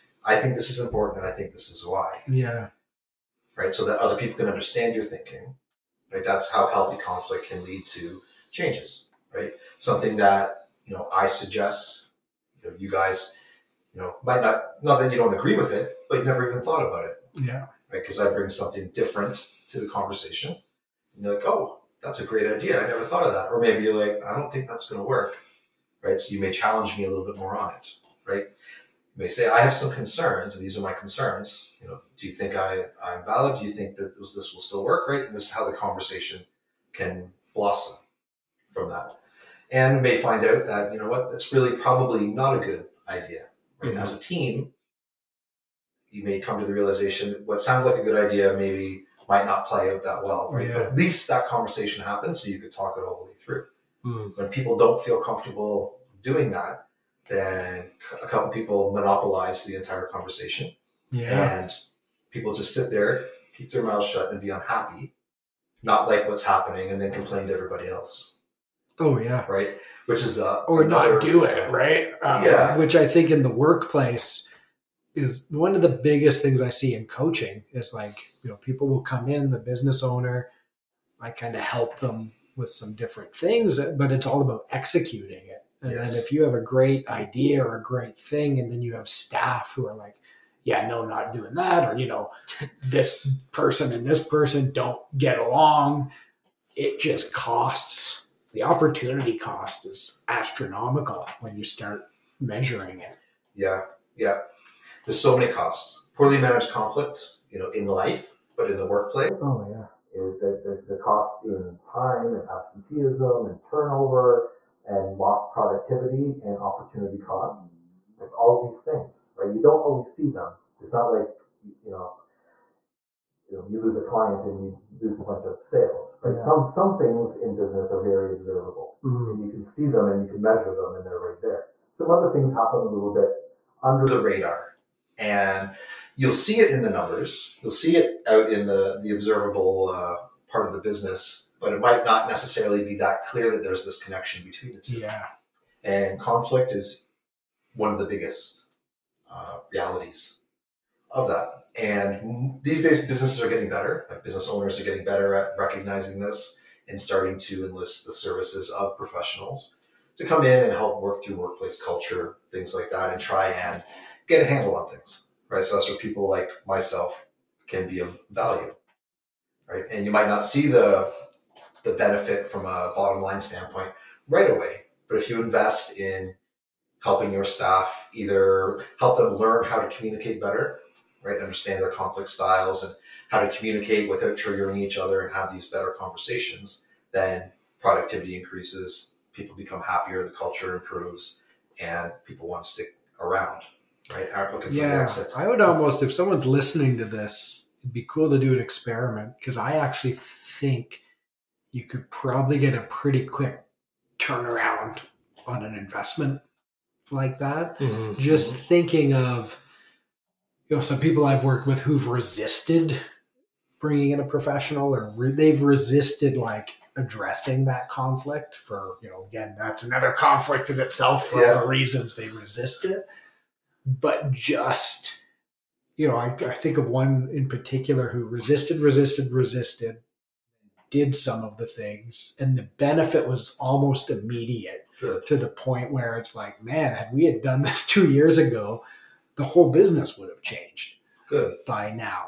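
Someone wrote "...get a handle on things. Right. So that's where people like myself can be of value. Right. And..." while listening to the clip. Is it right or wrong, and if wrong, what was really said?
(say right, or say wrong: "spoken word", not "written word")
right.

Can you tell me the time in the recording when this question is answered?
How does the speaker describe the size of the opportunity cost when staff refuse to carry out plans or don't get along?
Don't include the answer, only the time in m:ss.
1:40.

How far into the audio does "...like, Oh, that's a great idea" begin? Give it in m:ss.
0:21.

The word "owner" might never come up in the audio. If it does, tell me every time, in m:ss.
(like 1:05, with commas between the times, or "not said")
1:20, 2:34.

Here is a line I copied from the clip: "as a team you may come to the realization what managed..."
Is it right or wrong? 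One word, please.
wrong.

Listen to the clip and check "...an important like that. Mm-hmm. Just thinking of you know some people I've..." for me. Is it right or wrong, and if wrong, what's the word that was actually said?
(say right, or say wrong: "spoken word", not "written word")
wrong: "investment", not "important".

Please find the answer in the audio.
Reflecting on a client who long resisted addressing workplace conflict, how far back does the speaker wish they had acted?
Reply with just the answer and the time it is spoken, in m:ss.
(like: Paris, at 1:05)
2 years ago, at 3:57.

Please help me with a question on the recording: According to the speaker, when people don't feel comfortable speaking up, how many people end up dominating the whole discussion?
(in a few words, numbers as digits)
A couple people.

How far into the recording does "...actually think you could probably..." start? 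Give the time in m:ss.
3:19.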